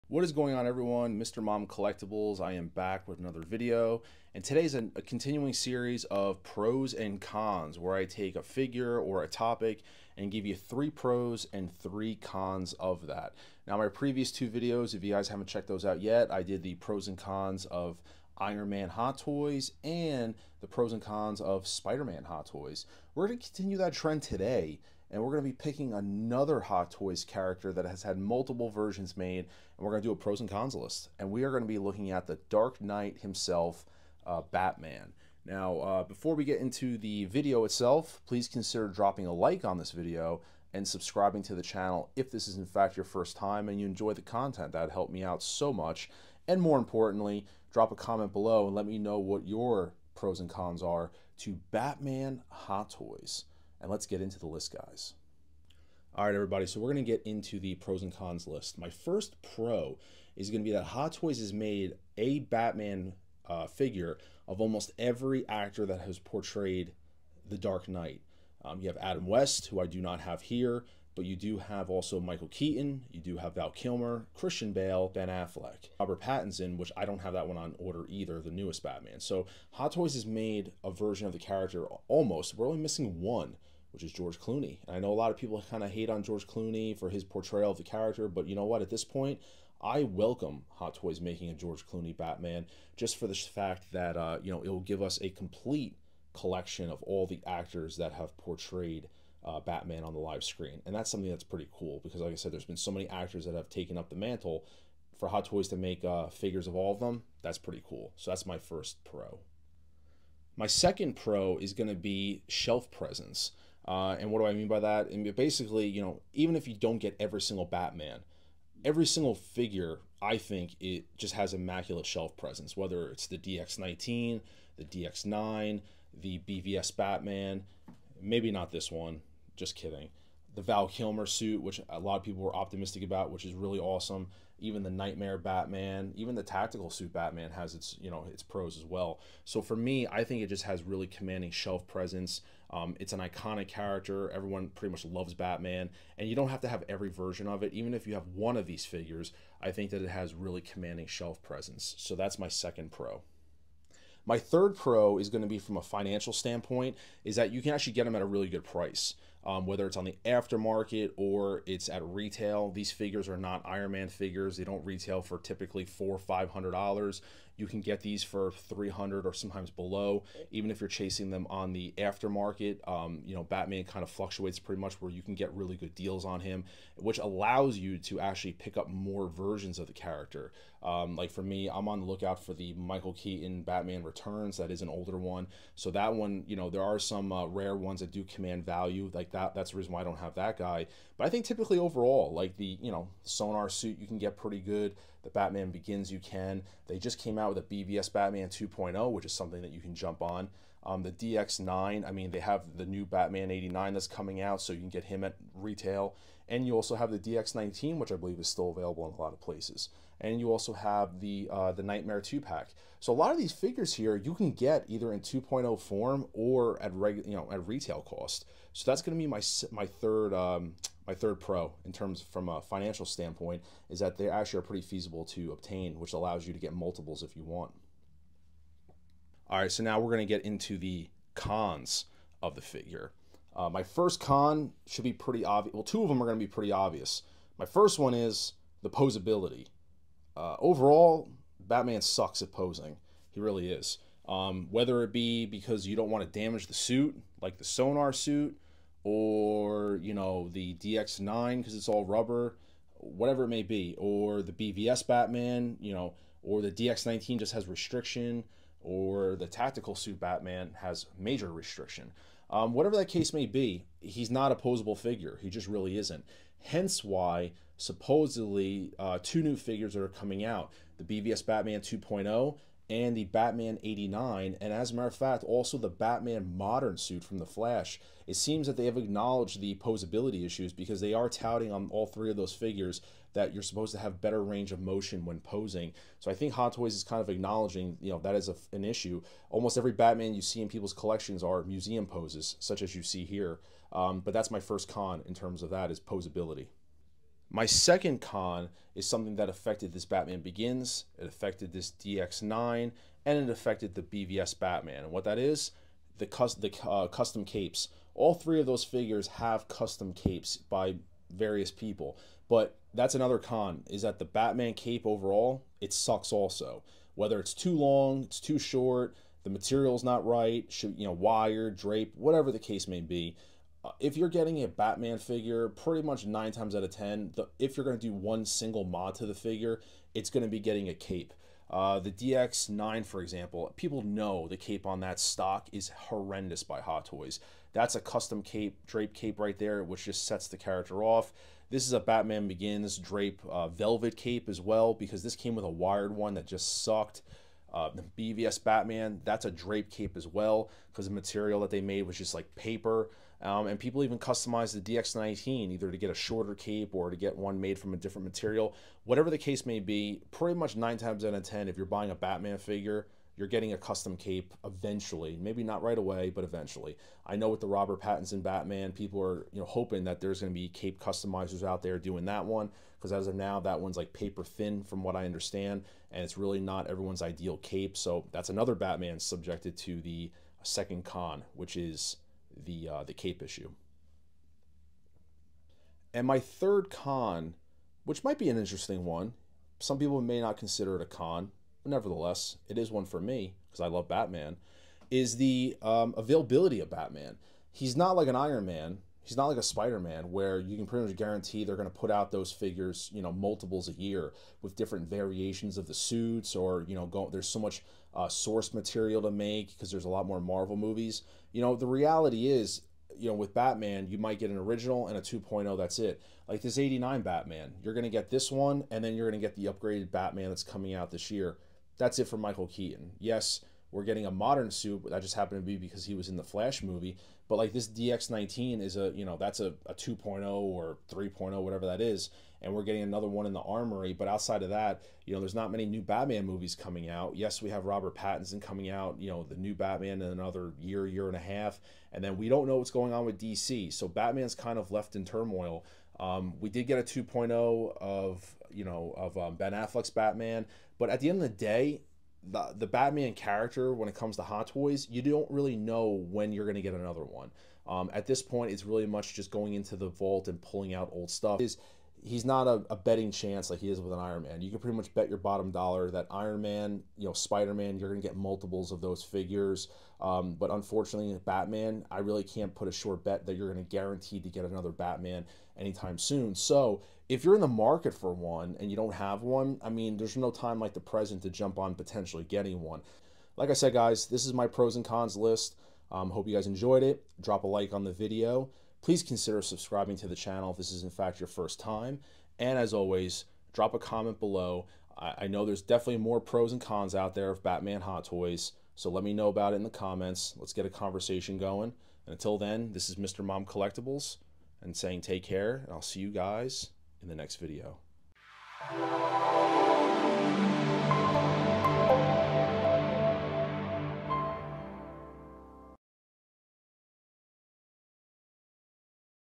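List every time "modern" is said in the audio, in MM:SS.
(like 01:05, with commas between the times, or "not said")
04:36, 07:04.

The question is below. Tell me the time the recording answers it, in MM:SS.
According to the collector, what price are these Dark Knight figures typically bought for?
02:48.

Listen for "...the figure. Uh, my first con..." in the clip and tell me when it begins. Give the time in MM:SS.
03:52.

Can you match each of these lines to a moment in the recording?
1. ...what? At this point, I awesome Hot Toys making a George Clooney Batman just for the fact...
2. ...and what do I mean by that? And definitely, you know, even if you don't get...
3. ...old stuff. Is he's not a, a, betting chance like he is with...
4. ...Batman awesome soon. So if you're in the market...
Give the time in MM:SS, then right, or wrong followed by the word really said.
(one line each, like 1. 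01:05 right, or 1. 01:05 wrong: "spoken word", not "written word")
1. 01:28 wrong: "welcome", not "awesome"
2. 01:54 wrong: "basically", not "definitely"
3. 07:41 right
4. 07:54 wrong: "anytime", not "awesome".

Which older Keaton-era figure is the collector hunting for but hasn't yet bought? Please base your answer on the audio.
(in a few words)
Michael Keaton Batman Returns.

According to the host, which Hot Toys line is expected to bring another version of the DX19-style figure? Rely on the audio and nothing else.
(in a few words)
the armory.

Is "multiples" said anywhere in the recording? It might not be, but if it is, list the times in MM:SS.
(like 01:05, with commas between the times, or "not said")
00:28, 03:46, 06:43, 07:48.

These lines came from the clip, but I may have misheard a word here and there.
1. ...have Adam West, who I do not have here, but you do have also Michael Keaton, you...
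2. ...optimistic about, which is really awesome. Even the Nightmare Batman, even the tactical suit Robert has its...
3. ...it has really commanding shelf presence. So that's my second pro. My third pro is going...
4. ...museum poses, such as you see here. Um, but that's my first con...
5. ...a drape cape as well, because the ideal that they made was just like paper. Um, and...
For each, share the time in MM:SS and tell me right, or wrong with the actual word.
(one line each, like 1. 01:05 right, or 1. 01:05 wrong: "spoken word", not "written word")
1. 01:08 right
2. 02:12 wrong: "Batman", not "Robert"
3. 02:30 right
4. 04:51 right
5. 05:49 wrong: "material", not "ideal".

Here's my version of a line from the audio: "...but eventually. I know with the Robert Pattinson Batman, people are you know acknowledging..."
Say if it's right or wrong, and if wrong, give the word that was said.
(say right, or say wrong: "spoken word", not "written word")
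wrong: "hoping", not "acknowledging".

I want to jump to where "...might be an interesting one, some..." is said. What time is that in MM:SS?
06:28.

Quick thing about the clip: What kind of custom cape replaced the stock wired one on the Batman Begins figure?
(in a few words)
velvet cape.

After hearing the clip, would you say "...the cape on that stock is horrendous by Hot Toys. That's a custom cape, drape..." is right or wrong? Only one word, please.
right.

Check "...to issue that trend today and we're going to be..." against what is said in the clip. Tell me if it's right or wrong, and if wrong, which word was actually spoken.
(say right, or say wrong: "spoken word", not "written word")
wrong: "continue", not "issue".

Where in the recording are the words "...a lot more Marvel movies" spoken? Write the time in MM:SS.
06:50.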